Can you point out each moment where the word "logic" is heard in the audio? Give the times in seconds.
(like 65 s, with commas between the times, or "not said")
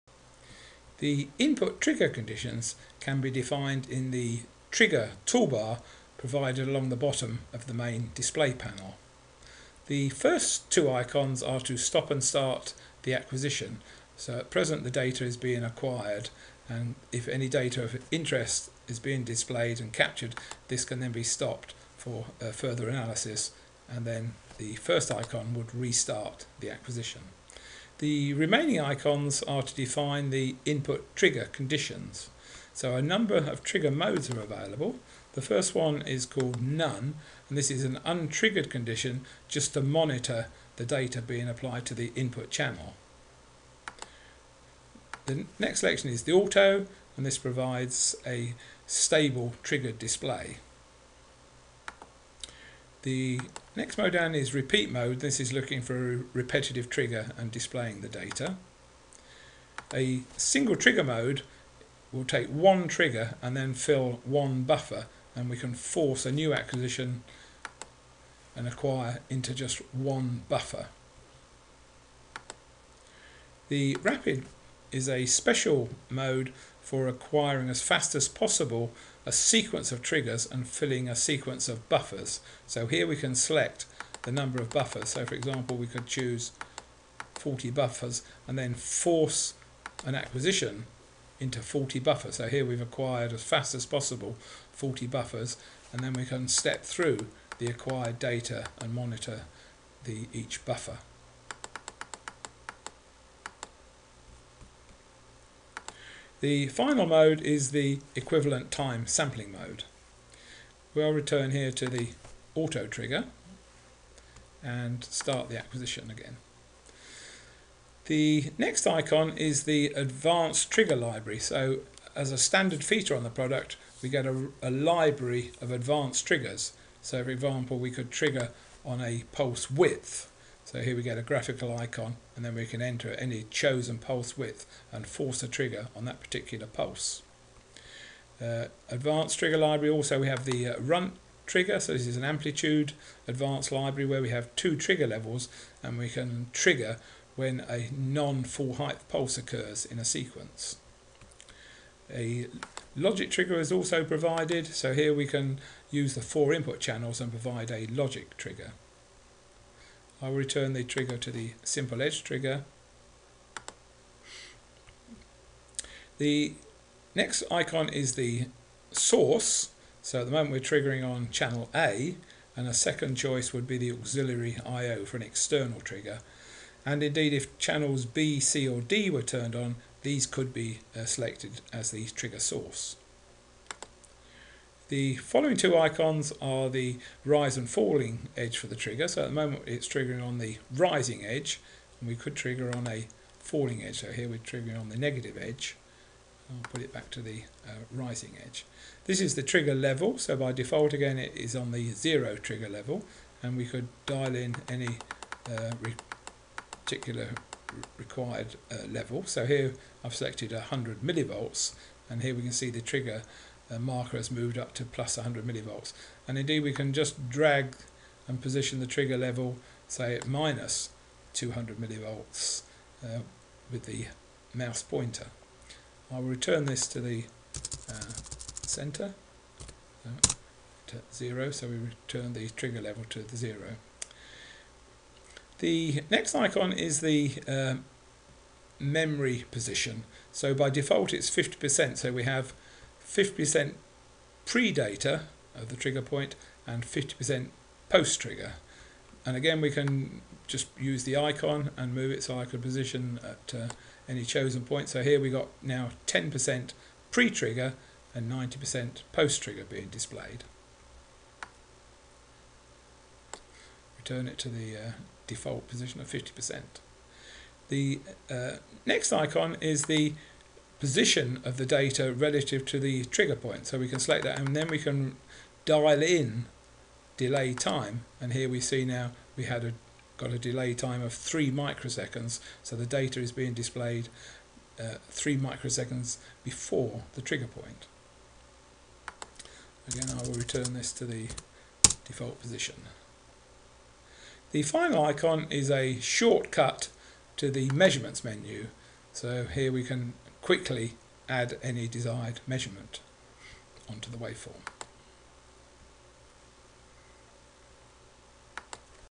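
152 s, 157 s.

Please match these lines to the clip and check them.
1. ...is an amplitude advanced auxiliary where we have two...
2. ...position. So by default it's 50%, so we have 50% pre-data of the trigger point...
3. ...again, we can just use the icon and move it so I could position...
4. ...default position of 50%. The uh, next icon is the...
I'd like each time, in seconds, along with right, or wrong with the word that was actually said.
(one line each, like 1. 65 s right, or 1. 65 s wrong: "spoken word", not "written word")
1. 142 s wrong: "library", not "auxiliary"
2. 239 s right
3. 249 s right
4. 265 s right.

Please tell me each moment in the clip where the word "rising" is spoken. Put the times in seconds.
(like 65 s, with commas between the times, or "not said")
190 s, 197 s.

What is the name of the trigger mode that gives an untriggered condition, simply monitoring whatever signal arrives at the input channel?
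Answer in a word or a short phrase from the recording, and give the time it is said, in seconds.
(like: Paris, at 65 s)
None, at 36 s.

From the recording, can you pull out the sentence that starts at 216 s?
And indeed we can just drag and position the trigger level, say at minus 200 millivolts uh, with the mouse pointer.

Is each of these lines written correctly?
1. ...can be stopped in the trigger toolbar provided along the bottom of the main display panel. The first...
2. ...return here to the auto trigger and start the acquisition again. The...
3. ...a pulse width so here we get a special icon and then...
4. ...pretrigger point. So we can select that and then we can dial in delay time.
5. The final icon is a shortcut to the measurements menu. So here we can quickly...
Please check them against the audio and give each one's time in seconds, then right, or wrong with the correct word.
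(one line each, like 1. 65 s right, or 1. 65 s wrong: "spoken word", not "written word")
1. 2 s wrong: "defined", not "stopped"
2. 111 s right
3. 128 s wrong: "graphical", not "special"
4. 273 s wrong: "trigger", not "pretrigger"
5. 294 s right.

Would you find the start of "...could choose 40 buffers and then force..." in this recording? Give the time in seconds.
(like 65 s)
85 s.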